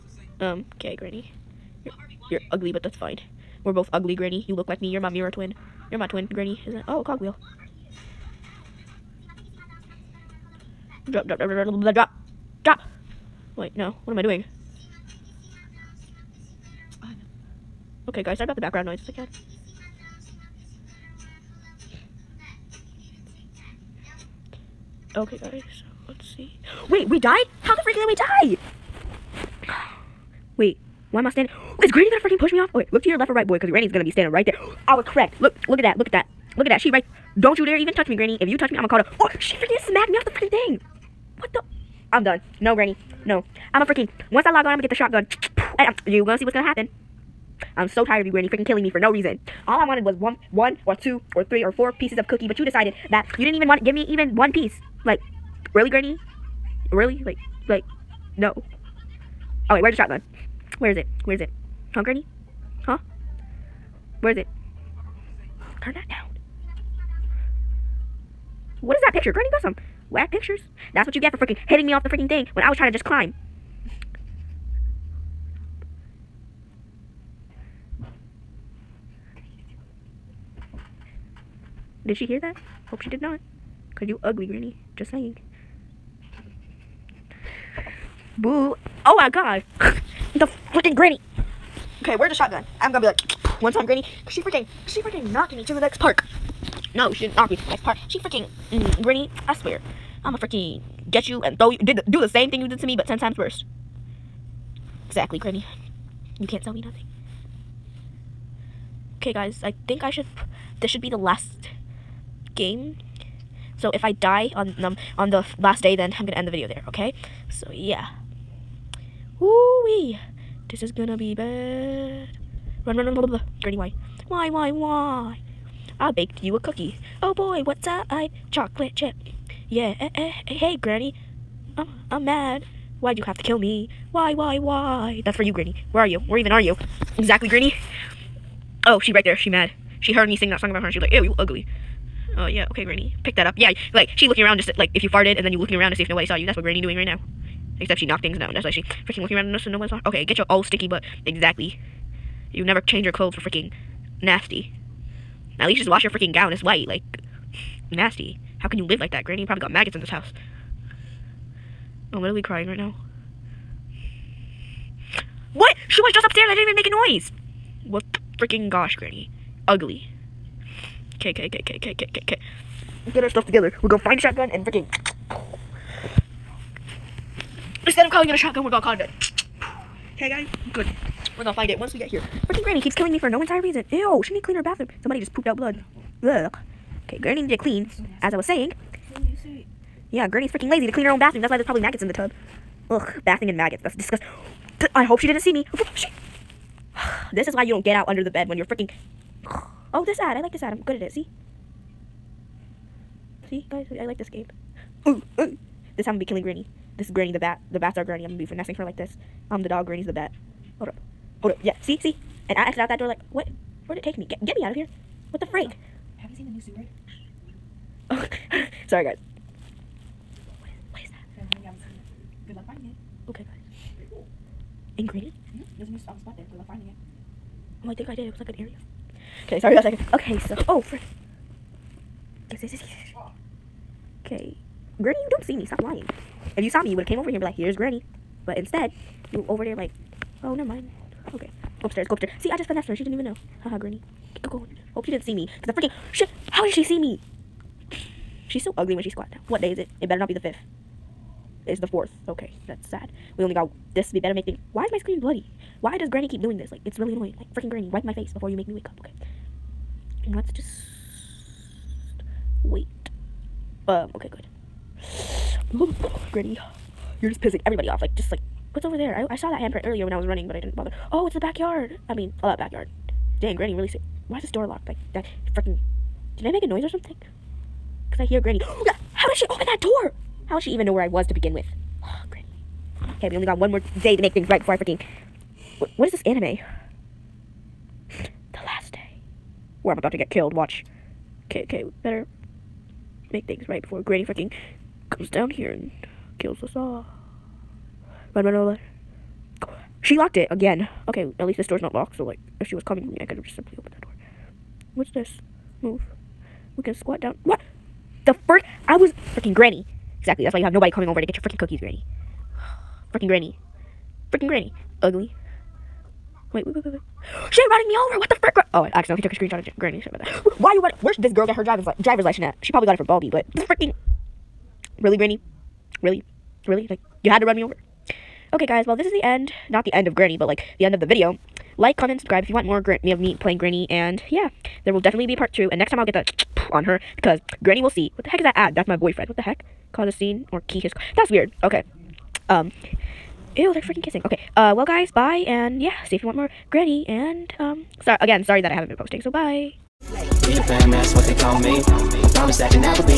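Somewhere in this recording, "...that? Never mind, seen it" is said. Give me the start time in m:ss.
3:41.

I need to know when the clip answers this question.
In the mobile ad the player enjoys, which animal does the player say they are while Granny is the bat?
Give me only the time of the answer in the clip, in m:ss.
3:29.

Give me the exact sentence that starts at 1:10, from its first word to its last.
That's what you get for freaking hitting me off the freaking thing when I was trying to just climb.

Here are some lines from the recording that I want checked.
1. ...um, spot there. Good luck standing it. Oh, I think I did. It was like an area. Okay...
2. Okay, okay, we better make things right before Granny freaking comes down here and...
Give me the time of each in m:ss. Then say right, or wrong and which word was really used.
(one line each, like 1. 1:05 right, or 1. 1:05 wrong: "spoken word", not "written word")
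1. 3:46 wrong: "finding", not "standing"
2. 4:51 right.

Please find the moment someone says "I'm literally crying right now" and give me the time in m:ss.
2:42.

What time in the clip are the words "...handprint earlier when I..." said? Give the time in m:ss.
4:29.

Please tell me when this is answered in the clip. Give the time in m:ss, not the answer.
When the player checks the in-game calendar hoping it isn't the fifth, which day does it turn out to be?
4:11.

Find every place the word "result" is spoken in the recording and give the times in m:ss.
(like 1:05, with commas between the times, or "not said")
not said.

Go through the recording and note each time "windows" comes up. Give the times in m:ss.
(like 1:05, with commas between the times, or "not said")
not said.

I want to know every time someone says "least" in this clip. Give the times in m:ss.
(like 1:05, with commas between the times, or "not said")
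2:35, 5:01.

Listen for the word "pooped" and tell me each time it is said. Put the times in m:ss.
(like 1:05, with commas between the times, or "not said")
3:05.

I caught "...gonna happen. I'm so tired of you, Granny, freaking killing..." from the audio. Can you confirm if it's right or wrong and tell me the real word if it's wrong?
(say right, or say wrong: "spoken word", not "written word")
right.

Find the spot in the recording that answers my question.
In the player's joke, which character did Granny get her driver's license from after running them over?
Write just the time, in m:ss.
5:23.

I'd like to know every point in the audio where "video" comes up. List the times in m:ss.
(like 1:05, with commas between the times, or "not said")
1:56, 5:31.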